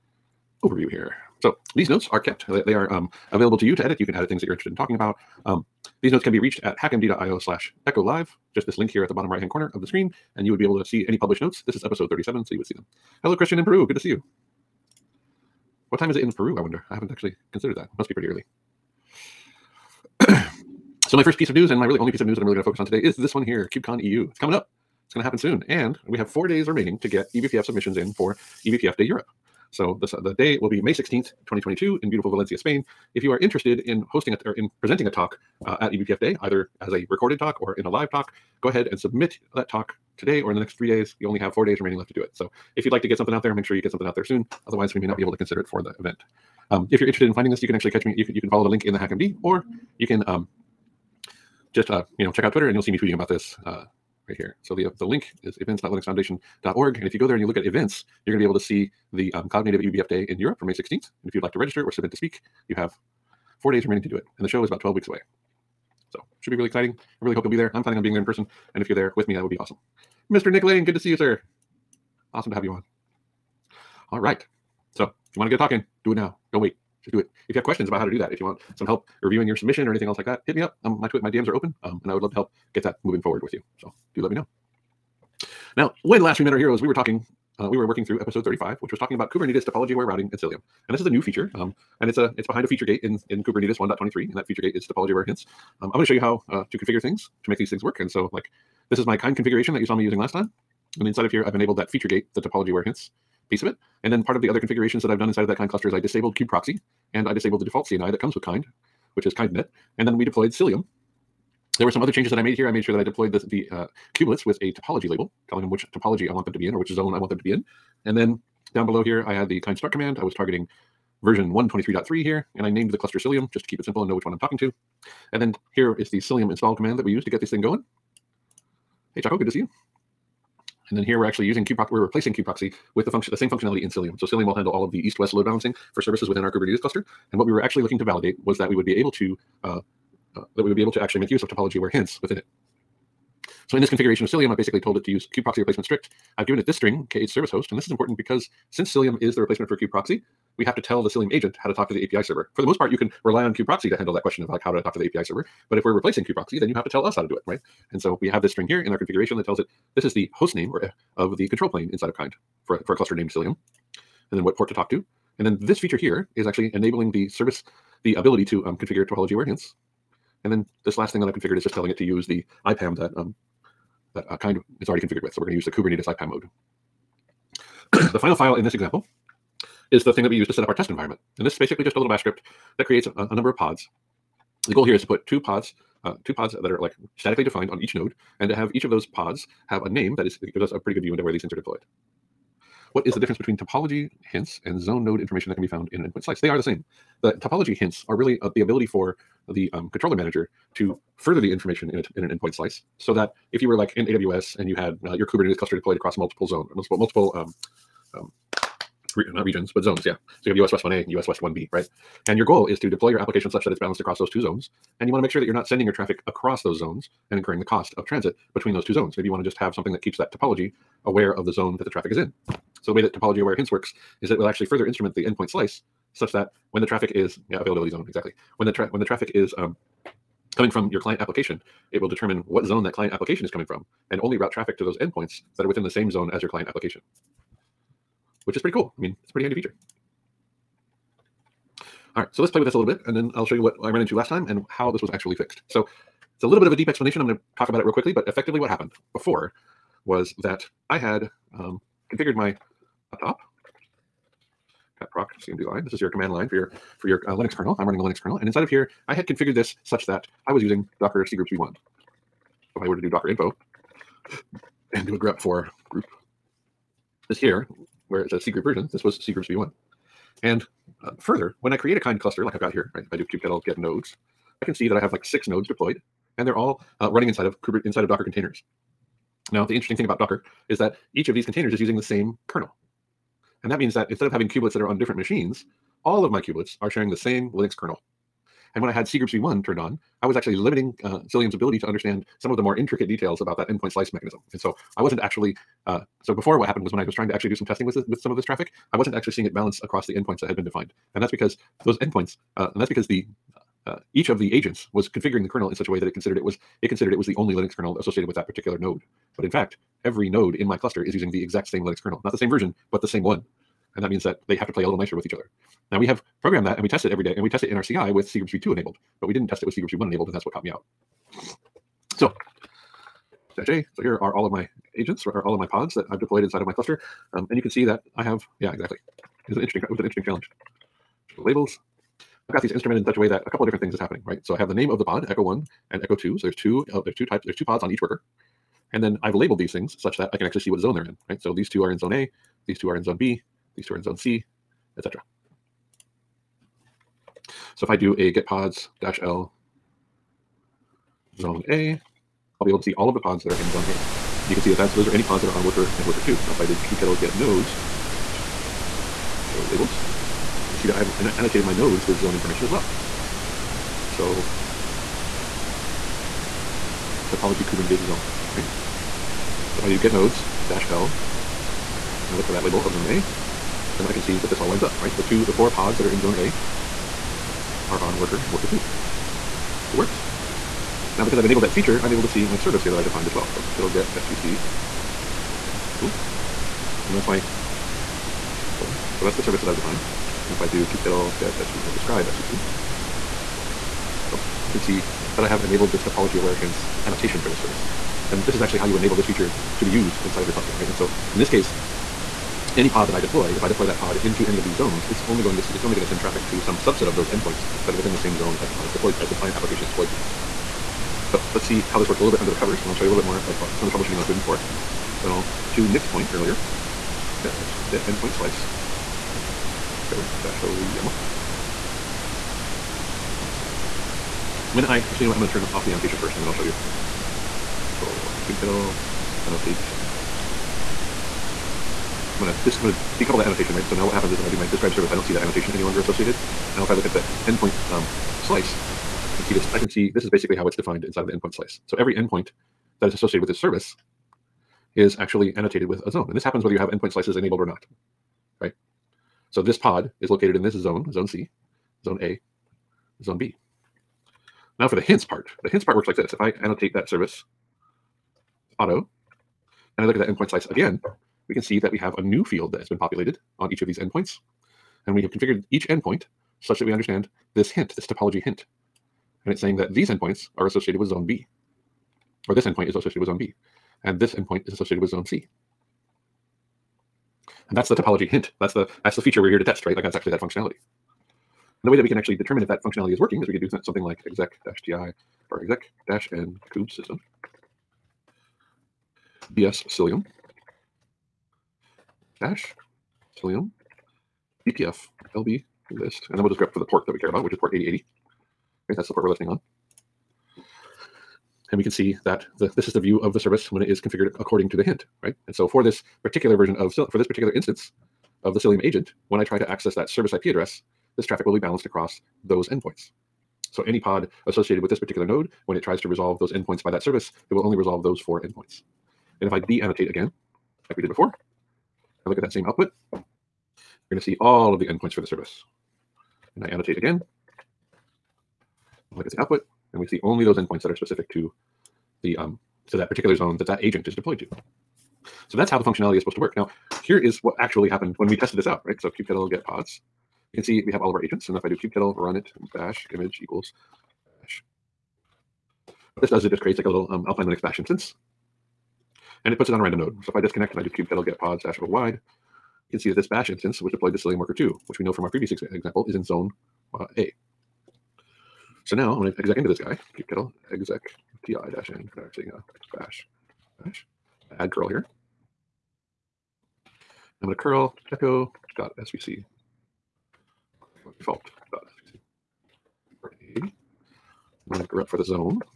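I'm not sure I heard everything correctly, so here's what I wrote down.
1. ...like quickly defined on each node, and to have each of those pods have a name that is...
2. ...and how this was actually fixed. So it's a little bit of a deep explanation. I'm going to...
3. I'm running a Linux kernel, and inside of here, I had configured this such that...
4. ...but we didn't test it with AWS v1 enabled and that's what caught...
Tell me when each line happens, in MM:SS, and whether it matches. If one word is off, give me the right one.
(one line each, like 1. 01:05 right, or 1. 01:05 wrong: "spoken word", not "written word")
1. 03:06 wrong: "statically", not "quickly"
2. 04:04 right
3. 04:17 right
4. 05:19 wrong: "Cgroups", not "AWS".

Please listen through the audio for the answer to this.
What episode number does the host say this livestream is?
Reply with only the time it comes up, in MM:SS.
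00:12.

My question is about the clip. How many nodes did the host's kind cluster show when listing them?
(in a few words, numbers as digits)
6.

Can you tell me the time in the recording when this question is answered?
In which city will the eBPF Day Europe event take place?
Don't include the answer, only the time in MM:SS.
00:32.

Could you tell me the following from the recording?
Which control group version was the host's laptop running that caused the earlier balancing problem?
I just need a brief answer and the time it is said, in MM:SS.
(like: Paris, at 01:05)
cgroups v1, at 04:29.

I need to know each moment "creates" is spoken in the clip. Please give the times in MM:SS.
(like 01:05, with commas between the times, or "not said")
03:02, 04:31, 09:06.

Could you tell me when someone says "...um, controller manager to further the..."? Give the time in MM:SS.
03:19.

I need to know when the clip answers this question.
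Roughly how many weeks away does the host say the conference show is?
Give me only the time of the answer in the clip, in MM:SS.
01:04.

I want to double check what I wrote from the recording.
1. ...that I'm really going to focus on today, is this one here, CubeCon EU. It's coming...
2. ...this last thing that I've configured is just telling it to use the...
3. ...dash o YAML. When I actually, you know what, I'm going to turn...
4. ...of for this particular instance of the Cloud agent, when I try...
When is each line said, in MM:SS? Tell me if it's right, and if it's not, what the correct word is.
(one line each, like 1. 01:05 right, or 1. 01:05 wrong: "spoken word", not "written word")
1. 00:22 right
2. 02:50 right
3. 07:00 right
4. 08:26 wrong: "Cilium", not "Cloud".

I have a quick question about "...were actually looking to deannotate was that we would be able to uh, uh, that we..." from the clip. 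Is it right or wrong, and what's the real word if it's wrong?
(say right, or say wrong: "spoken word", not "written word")
wrong: "validate", not "deannotate".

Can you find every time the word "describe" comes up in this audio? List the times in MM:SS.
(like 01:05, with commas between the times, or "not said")
06:31, 07:14.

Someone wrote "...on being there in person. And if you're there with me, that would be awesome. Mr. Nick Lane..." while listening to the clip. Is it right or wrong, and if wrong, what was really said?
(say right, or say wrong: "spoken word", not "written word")
right.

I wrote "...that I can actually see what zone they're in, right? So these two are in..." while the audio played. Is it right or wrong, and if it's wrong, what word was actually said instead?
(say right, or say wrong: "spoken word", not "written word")
right.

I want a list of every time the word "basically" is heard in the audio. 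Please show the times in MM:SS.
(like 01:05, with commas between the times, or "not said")
02:24, 03:01, 07:20.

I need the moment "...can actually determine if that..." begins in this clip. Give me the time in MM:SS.
08:02.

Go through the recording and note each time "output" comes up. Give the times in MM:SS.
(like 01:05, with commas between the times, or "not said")
08:42, 08:49.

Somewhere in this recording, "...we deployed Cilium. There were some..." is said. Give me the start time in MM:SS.
01:50.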